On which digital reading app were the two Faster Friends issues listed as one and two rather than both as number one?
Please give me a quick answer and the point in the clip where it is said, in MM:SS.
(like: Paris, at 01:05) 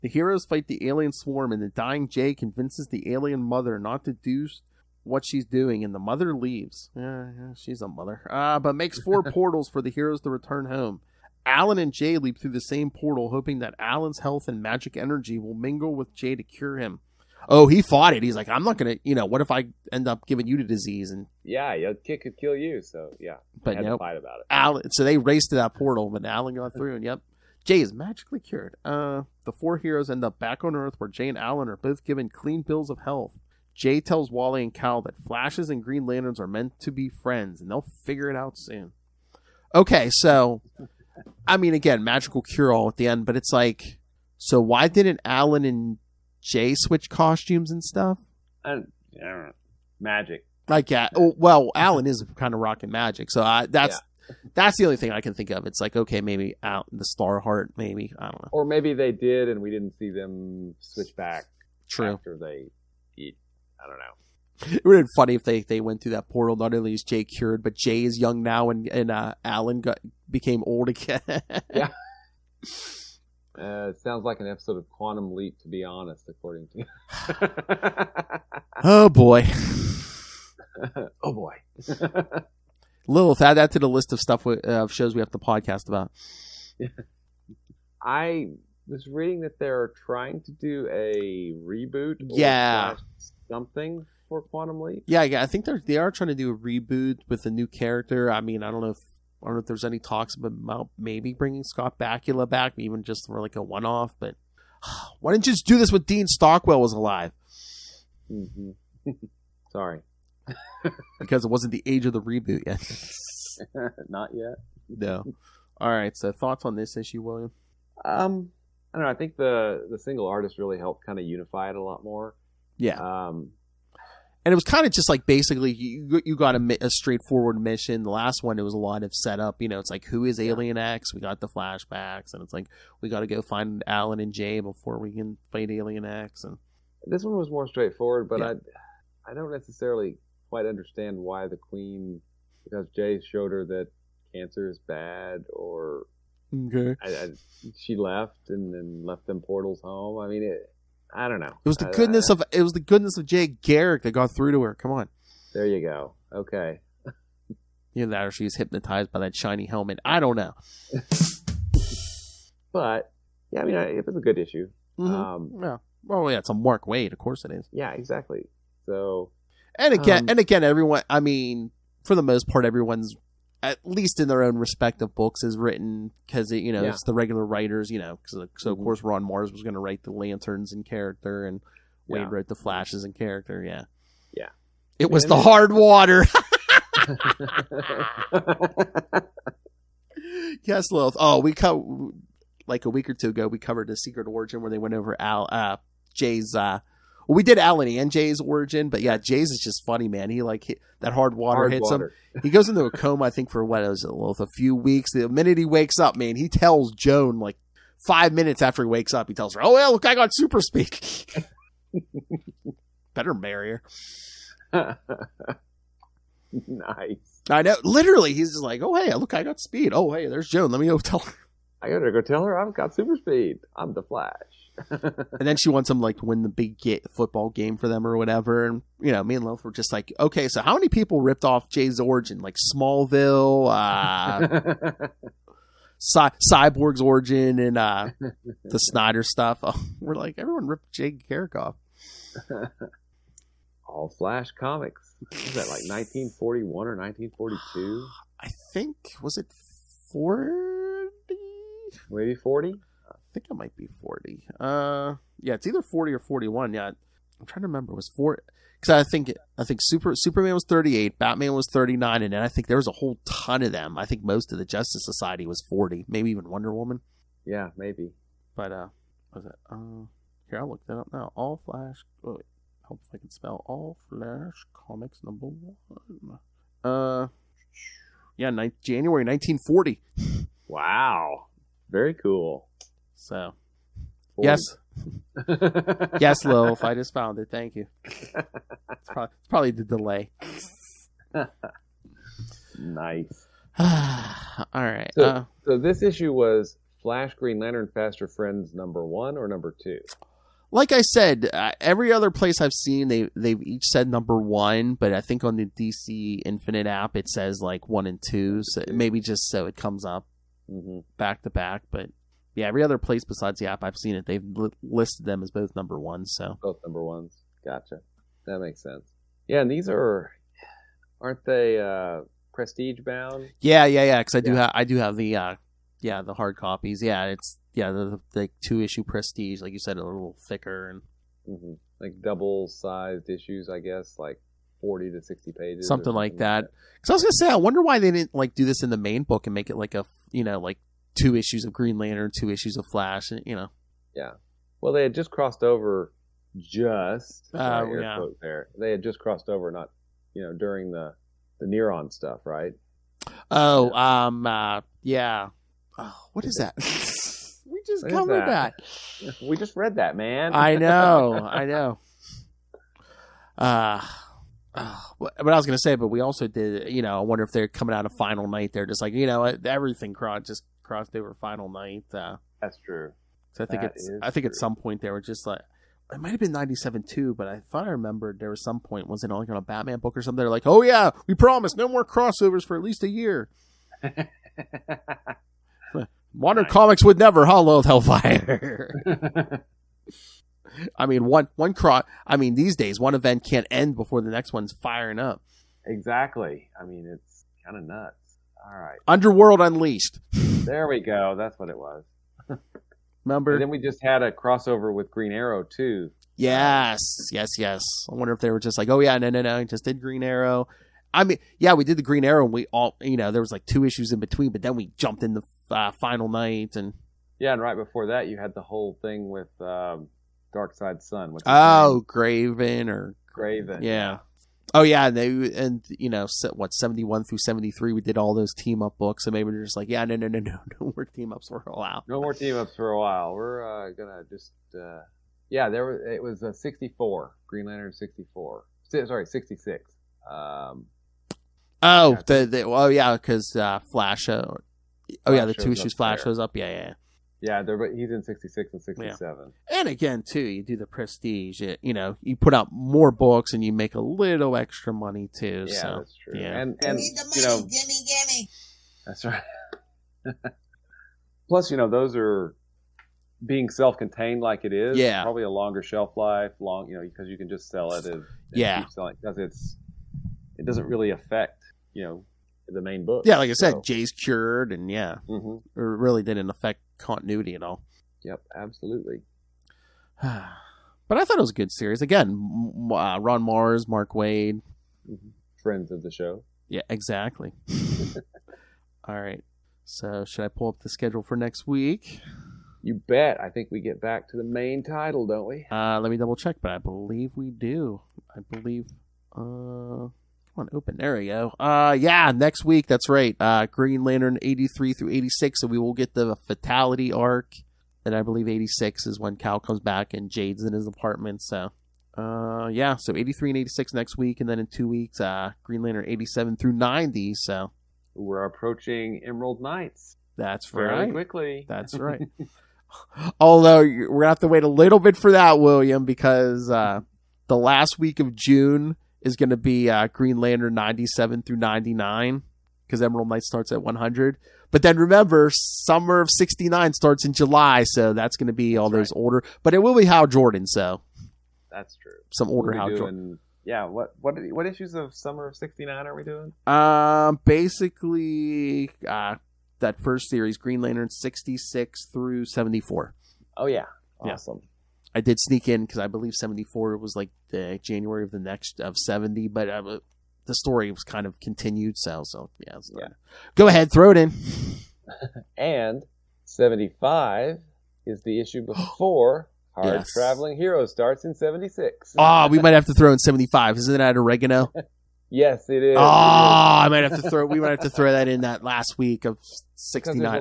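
DC Infinite, at 05:05.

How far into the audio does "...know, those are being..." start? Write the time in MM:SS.
07:41.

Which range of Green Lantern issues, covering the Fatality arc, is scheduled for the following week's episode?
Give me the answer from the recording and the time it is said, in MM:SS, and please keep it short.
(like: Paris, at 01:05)
83 through 86, at 08:24.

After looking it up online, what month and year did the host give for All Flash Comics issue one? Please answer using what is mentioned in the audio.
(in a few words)
January 1940.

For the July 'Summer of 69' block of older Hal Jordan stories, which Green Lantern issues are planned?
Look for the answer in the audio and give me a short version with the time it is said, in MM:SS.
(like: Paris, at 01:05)
66 through 74, at 09:11.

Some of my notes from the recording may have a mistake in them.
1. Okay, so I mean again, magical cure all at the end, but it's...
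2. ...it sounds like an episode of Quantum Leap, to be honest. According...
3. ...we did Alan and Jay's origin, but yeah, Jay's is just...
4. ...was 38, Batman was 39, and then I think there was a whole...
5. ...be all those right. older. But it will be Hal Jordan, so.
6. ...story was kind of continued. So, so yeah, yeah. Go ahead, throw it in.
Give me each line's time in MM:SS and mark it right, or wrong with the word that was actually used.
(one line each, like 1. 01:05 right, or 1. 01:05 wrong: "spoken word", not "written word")
1. 00:39 right
2. 01:13 right
3. 03:17 right
4. 04:20 right
5. 08:58 right
6. 09:20 right.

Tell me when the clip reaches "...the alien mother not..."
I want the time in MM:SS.
00:02.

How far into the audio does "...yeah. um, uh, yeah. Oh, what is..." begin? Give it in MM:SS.
05:53.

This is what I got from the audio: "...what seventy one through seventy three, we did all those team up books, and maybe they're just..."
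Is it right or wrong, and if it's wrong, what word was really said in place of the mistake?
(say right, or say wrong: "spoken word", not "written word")
right.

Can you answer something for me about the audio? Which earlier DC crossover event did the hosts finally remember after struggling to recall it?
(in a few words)
Underworld Unleashed.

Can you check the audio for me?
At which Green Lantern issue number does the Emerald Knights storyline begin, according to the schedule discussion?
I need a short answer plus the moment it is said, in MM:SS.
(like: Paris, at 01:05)
100, at 08:53.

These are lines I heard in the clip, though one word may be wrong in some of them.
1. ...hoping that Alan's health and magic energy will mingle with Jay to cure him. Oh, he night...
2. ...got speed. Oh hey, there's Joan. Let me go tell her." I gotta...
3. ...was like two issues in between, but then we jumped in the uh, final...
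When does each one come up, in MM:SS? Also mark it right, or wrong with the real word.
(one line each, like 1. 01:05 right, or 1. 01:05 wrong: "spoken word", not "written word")
1. 00:13 wrong: "fought", not "night"
2. 03:39 right
3. 06:53 right.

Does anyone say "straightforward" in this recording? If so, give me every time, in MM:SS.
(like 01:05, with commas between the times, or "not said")
02:06, 02:17.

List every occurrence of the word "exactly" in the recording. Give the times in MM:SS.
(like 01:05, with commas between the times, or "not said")
02:47, 06:35, 08:06.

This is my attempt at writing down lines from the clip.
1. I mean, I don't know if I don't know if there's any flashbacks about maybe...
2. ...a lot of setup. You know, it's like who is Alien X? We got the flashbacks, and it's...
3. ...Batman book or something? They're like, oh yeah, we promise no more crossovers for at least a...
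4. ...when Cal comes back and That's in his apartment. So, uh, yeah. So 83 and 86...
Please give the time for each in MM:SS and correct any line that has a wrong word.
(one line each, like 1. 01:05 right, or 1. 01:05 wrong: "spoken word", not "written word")
1. 01:38 wrong: "talks", not "flashbacks"
2. 02:08 right
3. 06:19 right
4. 08:29 wrong: "Jade", not "That".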